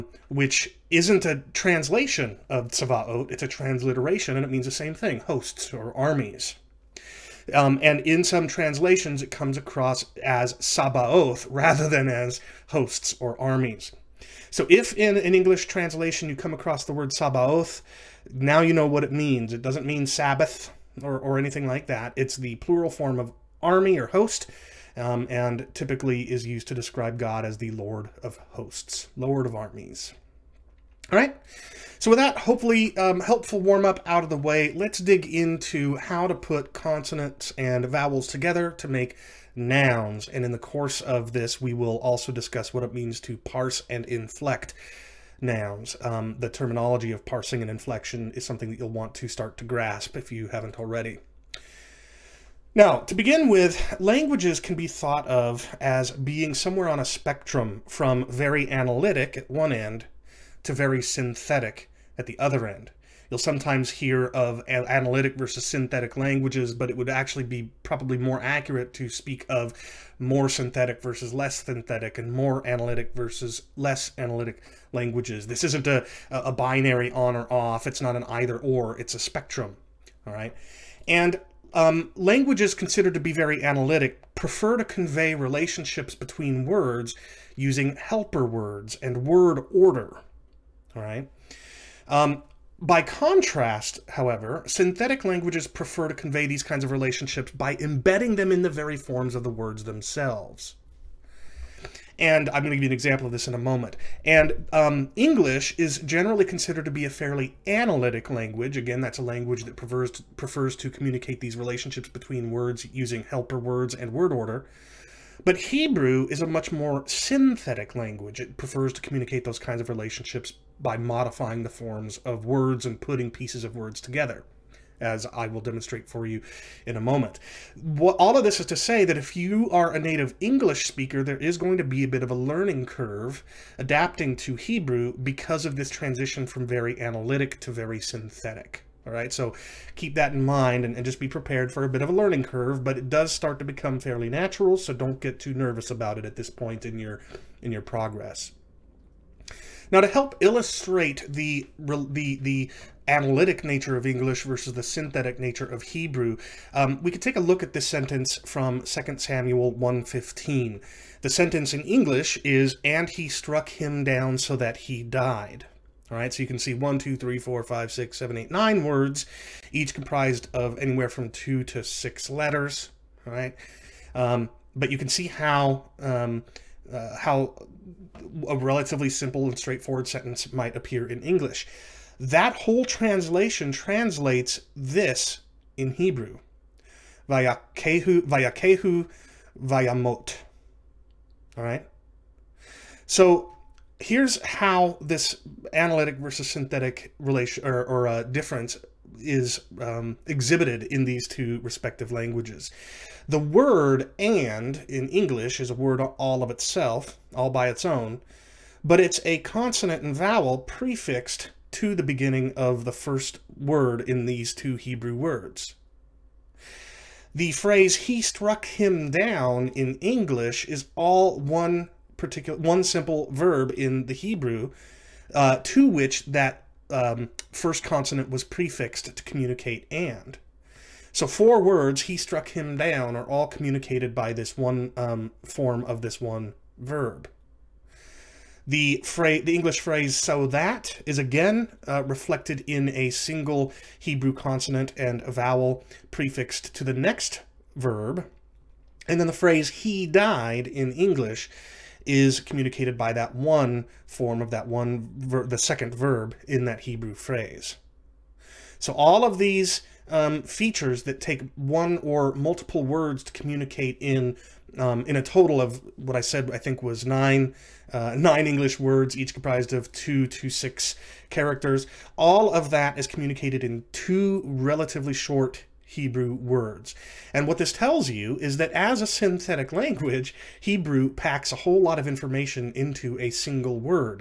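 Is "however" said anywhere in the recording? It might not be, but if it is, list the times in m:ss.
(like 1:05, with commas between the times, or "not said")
1:34.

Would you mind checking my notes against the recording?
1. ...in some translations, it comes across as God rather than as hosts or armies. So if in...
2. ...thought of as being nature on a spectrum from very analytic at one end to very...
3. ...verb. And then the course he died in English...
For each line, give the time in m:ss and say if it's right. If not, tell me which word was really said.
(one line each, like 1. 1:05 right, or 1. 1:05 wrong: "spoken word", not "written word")
1. 0:08 wrong: "Sabaoth", not "God"
2. 0:54 wrong: "somewhere", not "nature"
3. 4:07 wrong: "phrase", not "course".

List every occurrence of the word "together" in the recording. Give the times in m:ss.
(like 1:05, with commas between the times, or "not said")
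0:38, 2:04.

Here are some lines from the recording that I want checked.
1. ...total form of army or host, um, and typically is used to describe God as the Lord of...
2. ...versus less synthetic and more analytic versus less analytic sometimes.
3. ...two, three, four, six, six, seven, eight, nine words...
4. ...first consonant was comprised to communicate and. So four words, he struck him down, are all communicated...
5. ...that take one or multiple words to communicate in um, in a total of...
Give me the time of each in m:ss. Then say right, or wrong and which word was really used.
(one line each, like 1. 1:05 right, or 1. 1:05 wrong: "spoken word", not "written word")
1. 0:22 wrong: "plural", not "total"
2. 1:11 wrong: "languages", not "sometimes"
3. 2:46 wrong: "five", not "six"
4. 3:47 wrong: "prefixed", not "comprised"
5. 4:21 right.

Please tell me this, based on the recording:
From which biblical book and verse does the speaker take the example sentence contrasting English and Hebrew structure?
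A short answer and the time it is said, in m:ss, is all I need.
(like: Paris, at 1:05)
2 Samuel 1:15, at 2:38.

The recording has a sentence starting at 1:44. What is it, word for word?
And um, English is generally considered to be a fairly analytic language.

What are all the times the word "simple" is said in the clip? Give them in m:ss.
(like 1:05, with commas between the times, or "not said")
2:59, 3:42.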